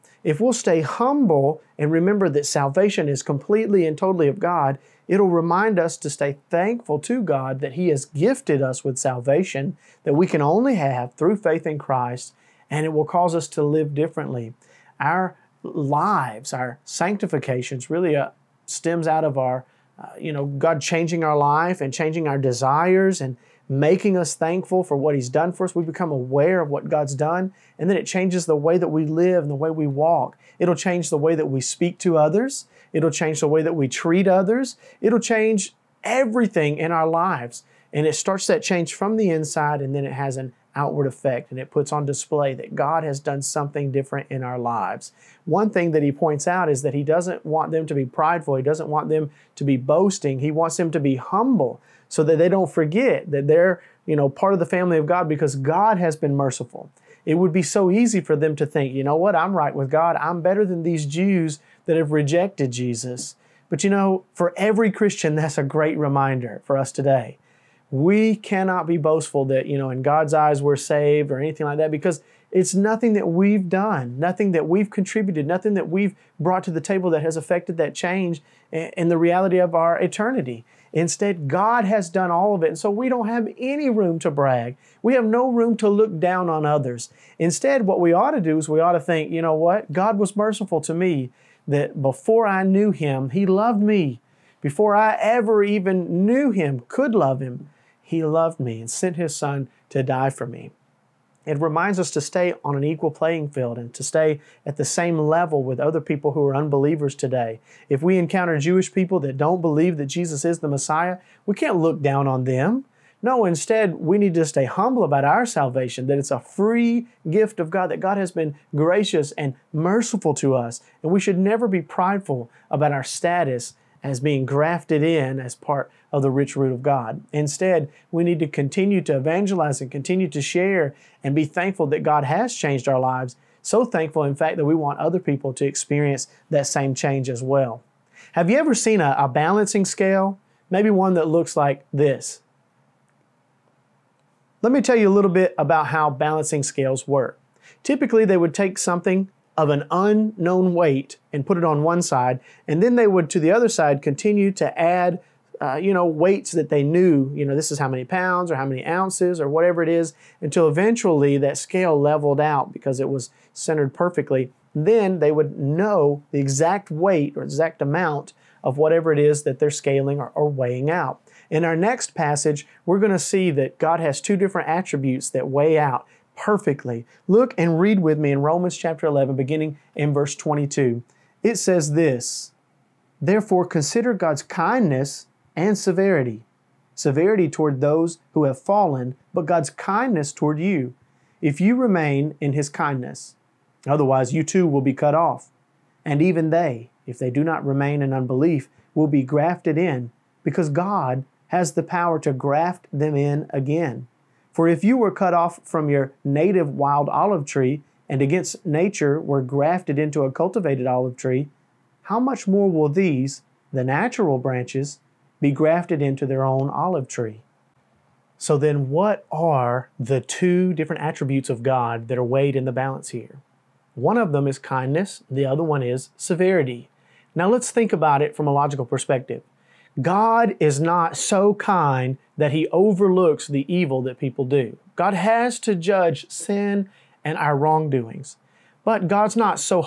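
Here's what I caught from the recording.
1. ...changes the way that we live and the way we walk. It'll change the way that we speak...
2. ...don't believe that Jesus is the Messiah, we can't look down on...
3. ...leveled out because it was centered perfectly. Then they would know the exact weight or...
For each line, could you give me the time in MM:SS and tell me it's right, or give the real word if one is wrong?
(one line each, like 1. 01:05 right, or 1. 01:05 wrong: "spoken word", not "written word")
1. 00:28 right
2. 01:49 right
3. 02:42 right.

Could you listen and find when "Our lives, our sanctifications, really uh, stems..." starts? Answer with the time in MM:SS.
00:15.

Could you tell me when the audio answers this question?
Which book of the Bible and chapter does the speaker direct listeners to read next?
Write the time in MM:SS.
02:58.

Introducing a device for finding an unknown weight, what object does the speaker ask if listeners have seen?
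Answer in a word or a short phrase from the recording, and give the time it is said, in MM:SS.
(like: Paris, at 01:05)
Balancing scale, at 02:19.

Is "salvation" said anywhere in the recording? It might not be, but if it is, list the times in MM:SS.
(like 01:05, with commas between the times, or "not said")
00:02, 00:08, 01:55.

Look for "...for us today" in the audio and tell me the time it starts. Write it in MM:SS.
01:06.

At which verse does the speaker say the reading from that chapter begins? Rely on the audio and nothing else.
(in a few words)
22.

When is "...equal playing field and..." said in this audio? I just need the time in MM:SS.
01:42.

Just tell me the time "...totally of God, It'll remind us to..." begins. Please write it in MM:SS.
00:03.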